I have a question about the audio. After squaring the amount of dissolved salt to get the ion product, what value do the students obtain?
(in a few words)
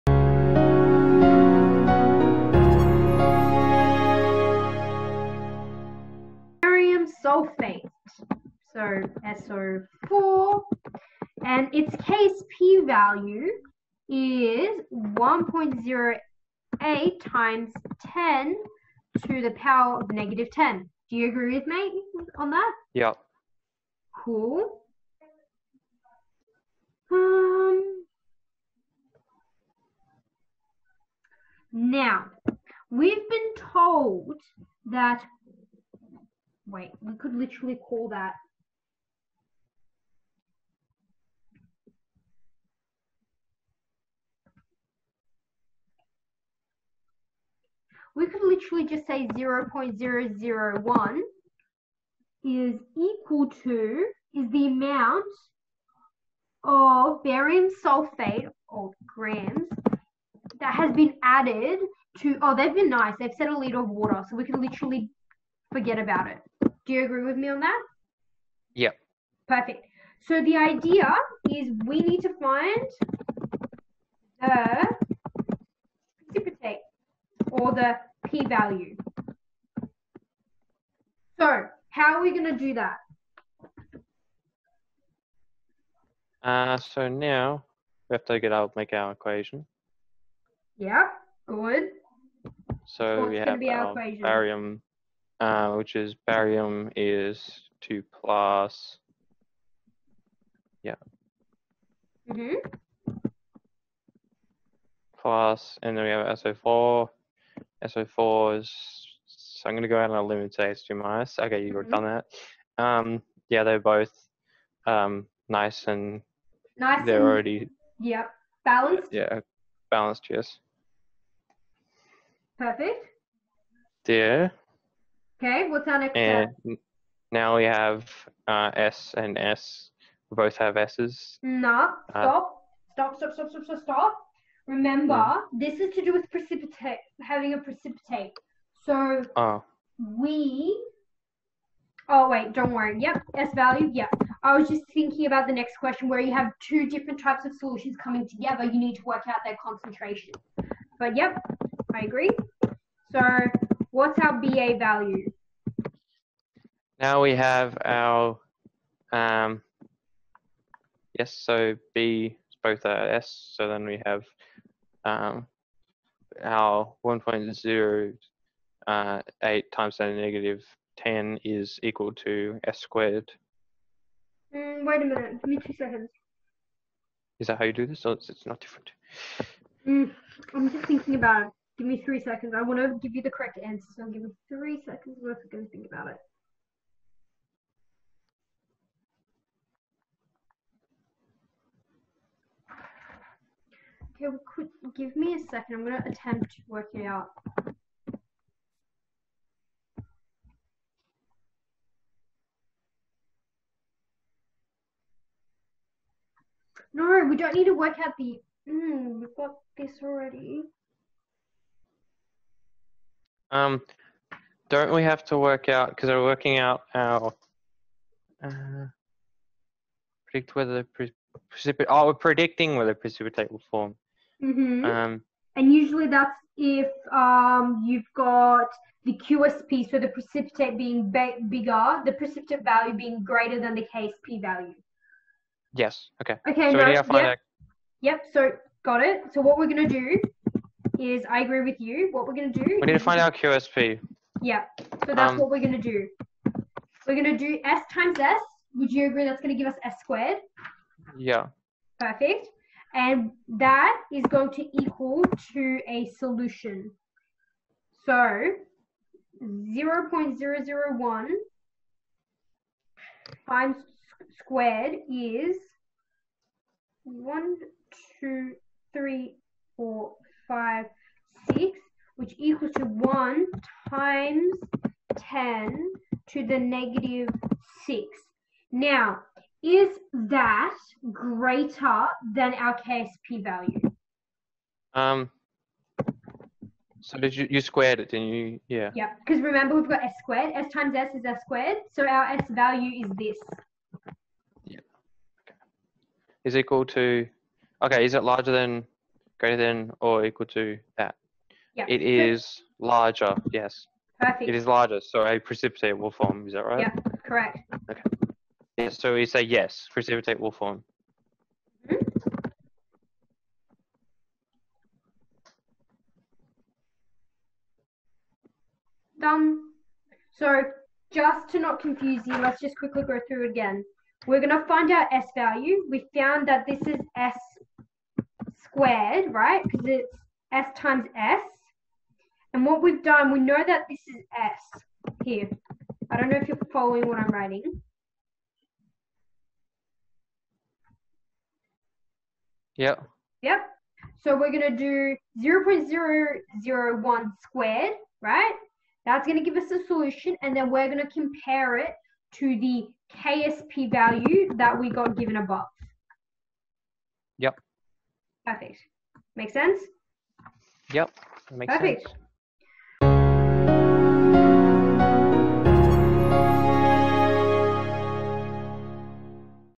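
1 x 10^-6.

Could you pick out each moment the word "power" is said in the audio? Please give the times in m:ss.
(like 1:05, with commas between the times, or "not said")
0:19.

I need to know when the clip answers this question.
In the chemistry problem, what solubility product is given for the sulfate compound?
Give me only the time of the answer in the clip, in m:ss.
0:15.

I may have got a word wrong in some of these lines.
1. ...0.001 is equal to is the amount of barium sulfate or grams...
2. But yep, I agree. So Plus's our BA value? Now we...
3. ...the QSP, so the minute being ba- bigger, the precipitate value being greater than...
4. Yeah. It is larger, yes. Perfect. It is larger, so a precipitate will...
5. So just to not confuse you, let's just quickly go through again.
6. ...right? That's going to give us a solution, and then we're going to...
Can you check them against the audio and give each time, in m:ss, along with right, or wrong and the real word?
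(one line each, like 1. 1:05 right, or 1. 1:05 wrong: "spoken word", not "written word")
1. 0:49 right
2. 2:30 wrong: "What", not "Plus"
3. 3:49 wrong: "precipitate", not "minute"
4. 5:01 right
5. 5:20 right
6. 5:48 right.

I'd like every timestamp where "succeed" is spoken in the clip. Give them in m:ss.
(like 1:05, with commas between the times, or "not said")
not said.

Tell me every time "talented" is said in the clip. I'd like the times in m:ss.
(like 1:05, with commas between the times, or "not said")
not said.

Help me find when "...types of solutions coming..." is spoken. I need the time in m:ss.
2:27.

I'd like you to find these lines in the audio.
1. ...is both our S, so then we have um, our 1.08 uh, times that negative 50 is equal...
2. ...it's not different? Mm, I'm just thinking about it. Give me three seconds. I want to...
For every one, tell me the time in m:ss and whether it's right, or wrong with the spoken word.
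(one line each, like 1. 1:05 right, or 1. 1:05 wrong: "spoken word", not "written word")
1. 2:42 wrong: "10", not "50"
2. 2:58 right.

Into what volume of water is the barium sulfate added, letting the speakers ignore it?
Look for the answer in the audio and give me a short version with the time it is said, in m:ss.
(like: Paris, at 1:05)
a liter, at 1:03.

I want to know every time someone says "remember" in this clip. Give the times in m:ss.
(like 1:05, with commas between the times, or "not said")
2:14, 4:49.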